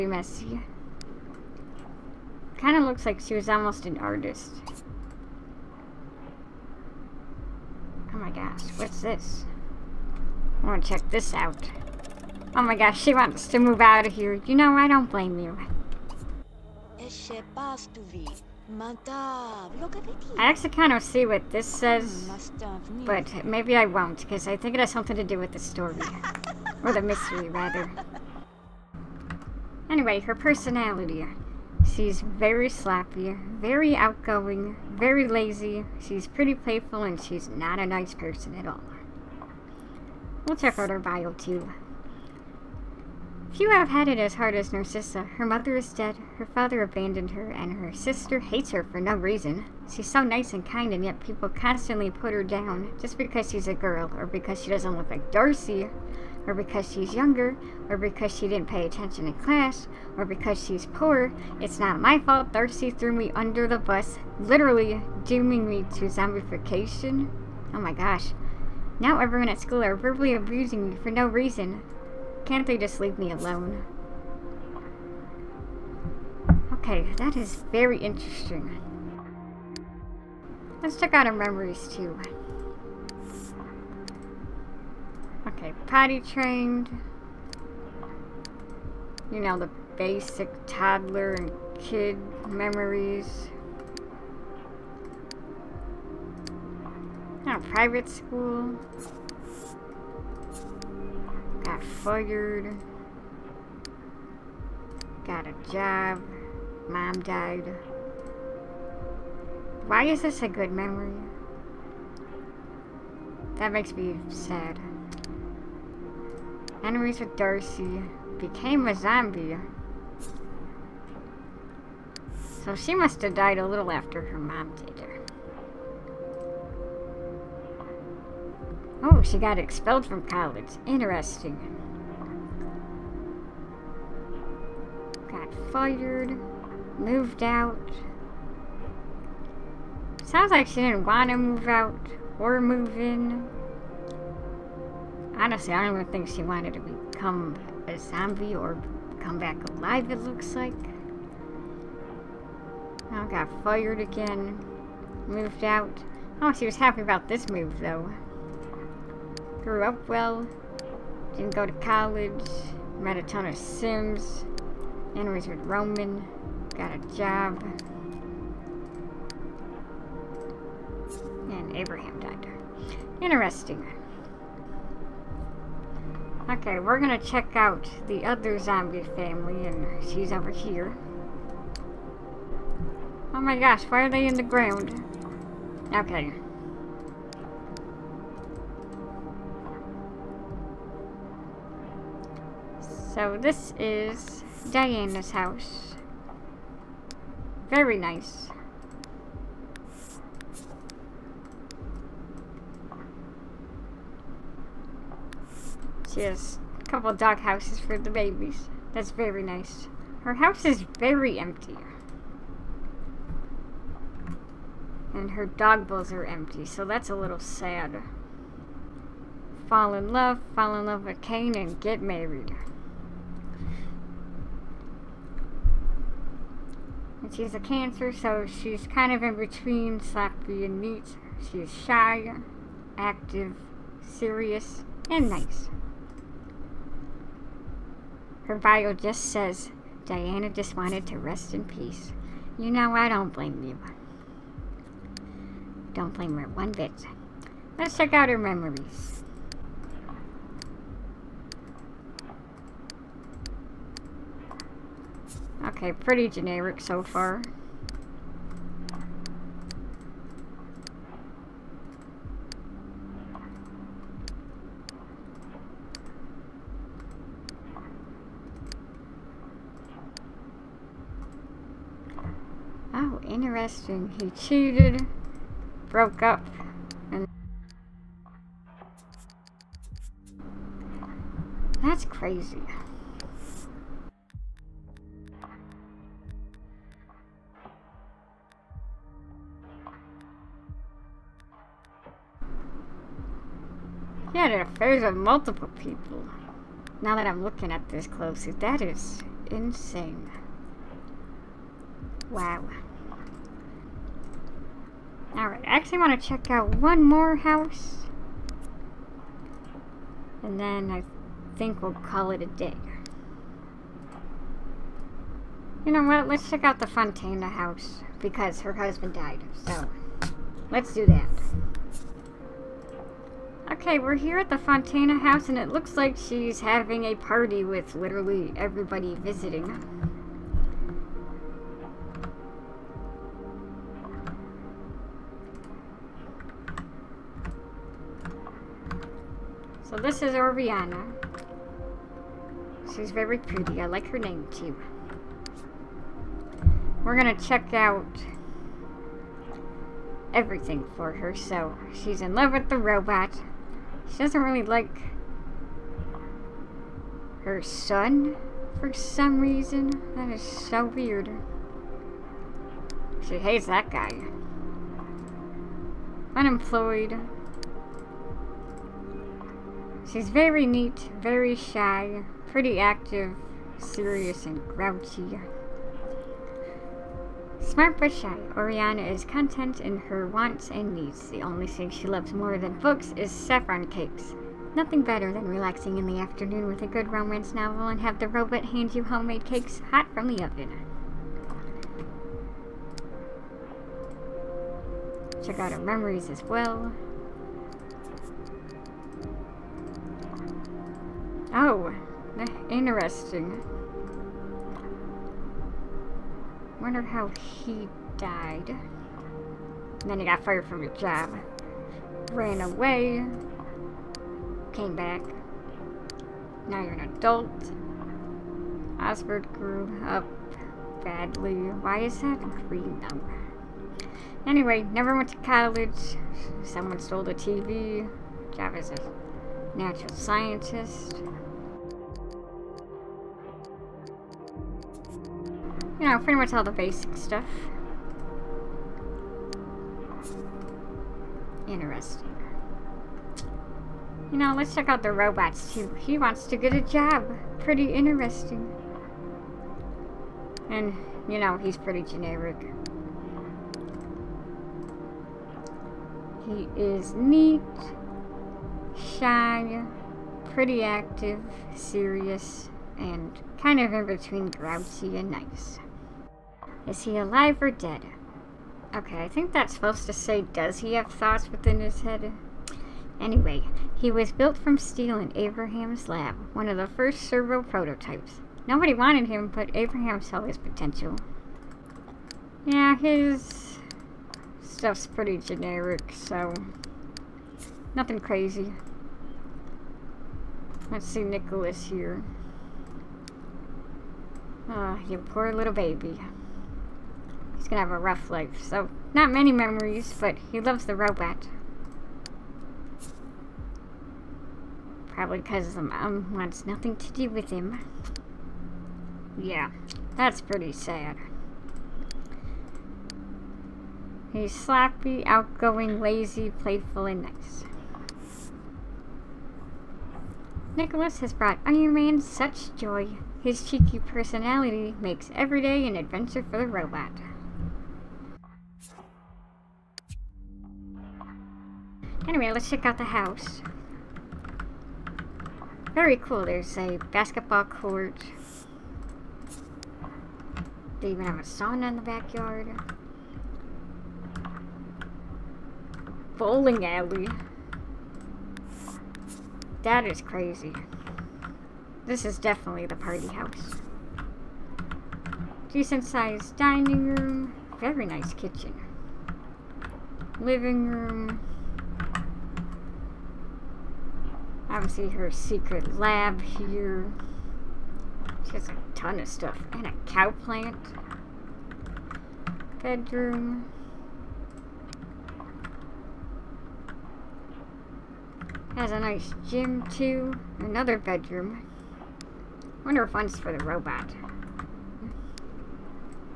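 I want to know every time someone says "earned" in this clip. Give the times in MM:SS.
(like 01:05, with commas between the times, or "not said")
not said.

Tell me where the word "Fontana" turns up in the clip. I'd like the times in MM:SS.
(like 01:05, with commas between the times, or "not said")
05:16, 05:24.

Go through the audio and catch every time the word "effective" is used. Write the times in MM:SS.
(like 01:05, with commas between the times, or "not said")
not said.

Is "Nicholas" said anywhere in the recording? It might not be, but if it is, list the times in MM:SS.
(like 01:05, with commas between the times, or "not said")
08:11, 08:40.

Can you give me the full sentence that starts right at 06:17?
Smart but shy, Oriana is content in her wants and needs.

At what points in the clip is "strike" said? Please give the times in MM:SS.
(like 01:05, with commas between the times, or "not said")
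not said.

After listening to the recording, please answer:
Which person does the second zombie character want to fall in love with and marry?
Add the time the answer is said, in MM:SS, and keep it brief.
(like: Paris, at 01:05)
Kane, at 03:40.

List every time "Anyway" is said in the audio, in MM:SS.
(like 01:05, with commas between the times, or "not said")
00:29, 07:04, 07:53, 08:52.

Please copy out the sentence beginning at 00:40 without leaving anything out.
We'll check out her bio, too.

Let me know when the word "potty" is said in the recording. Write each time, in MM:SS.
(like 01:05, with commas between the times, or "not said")
01:25.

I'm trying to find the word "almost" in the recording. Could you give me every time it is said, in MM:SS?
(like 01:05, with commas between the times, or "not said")
00:03.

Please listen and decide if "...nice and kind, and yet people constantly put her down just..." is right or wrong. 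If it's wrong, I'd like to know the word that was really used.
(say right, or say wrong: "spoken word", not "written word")
right.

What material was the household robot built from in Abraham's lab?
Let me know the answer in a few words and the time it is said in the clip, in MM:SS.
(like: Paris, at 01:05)
steel, at 07:54.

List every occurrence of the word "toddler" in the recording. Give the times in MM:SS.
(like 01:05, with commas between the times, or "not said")
01:30.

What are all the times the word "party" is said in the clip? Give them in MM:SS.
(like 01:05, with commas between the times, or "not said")
05:27, 09:12.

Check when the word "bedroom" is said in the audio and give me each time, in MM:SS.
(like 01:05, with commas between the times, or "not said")
09:32, 09:40.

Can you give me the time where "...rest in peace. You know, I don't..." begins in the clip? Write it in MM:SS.
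04:01.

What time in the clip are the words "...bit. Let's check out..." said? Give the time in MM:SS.
04:06.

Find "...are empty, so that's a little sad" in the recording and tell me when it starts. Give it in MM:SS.
03:36.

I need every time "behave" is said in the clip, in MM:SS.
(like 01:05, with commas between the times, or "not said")
not said.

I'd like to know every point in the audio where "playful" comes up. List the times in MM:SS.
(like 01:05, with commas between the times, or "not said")
00:36, 08:36.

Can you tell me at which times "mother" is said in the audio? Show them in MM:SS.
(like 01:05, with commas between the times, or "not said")
00:45.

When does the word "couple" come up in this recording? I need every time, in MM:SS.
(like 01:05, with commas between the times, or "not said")
03:26.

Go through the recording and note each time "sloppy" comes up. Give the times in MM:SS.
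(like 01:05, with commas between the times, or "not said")
00:32, 03:50, 08:34.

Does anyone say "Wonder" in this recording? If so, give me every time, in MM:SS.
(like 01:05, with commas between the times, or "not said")
06:46, 09:42.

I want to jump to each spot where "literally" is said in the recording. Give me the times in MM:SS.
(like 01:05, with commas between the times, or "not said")
01:04, 05:27.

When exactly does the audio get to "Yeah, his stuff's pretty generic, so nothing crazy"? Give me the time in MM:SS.
08:02.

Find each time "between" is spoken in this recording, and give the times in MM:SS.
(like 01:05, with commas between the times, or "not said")
03:49, 07:44.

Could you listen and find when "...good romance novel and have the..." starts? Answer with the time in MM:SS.
06:26.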